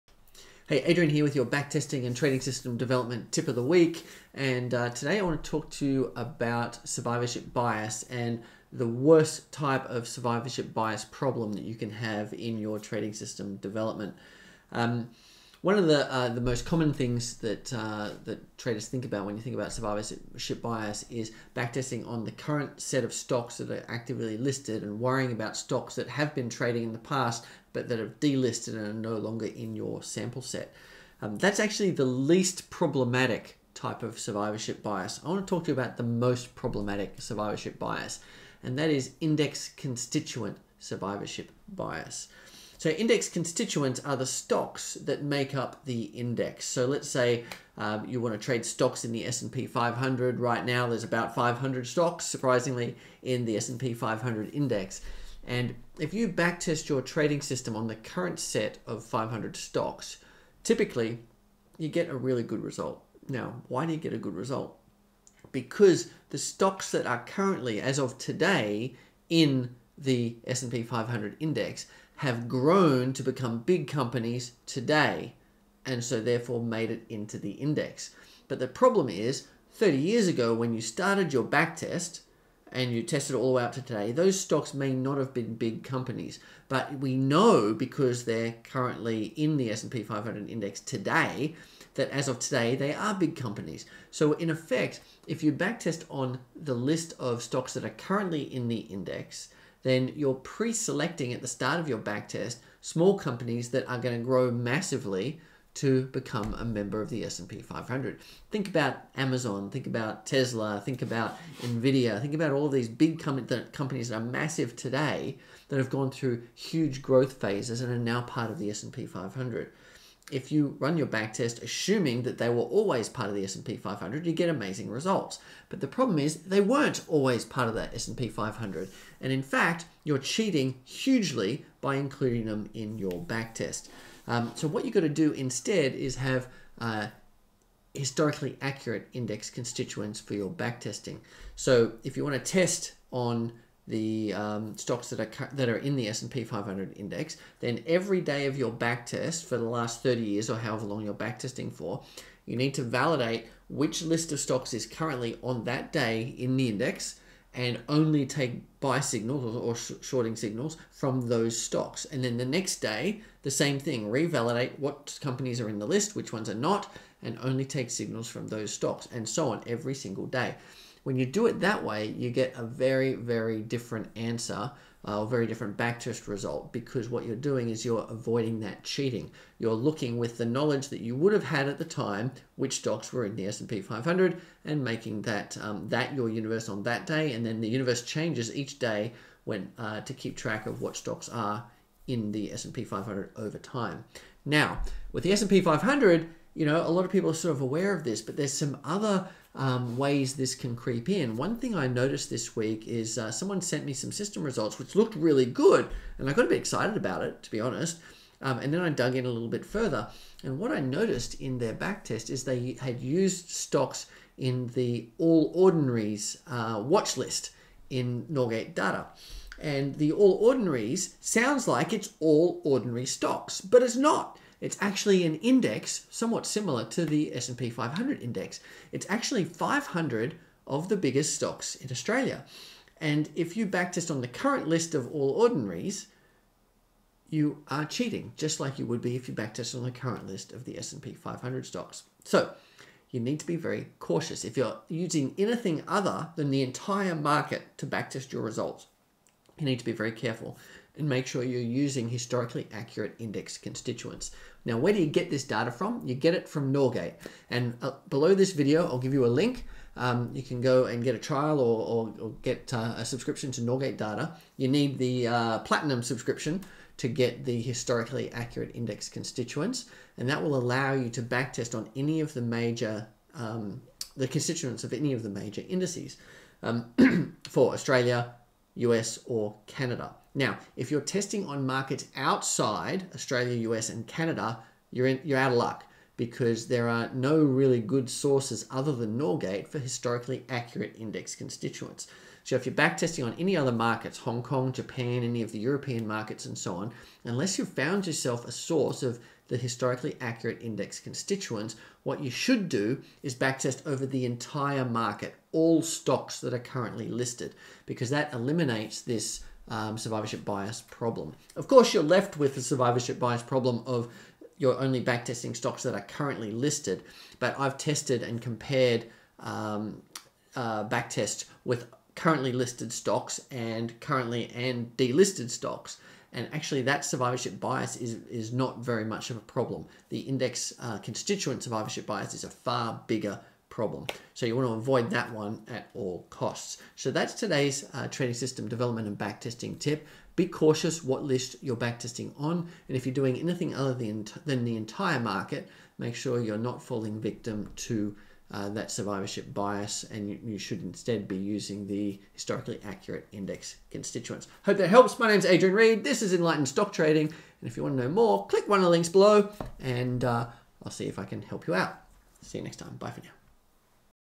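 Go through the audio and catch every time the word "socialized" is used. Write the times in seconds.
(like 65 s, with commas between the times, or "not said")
not said.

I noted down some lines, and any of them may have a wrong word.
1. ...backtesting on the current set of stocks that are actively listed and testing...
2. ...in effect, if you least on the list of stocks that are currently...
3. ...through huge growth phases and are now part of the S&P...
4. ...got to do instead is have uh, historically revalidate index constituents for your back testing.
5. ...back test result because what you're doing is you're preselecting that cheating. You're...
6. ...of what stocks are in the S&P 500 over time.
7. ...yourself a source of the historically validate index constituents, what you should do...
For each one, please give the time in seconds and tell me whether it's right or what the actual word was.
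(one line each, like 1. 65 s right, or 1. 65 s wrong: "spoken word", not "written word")
1. 21 s wrong: "worrying", not "testing"
2. 94 s wrong: "backtest", not "least"
3. 116 s right
4. 134 s wrong: "accurate", not "revalidate"
5. 175 s wrong: "avoiding", not "preselecting"
6. 190 s right
7. 298 s wrong: "accurate", not "validate".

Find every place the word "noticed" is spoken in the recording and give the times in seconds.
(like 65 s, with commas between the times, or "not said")
201 s, 210 s.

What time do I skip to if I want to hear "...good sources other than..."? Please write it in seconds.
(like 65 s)
287 s.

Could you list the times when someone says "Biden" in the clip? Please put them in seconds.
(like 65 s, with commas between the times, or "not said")
not said.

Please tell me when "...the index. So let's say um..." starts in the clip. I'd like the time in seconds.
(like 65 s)
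45 s.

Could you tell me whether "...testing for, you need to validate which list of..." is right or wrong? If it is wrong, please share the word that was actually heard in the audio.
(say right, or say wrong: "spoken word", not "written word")
right.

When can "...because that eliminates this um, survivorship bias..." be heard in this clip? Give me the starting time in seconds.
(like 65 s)
307 s.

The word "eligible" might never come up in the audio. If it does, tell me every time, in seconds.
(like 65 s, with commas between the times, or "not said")
not said.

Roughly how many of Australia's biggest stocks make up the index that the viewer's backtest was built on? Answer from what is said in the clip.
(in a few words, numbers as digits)
500.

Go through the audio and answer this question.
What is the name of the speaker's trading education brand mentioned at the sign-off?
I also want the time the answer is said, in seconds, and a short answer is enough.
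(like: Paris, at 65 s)
Enlightened Stock Trading, at 356 s.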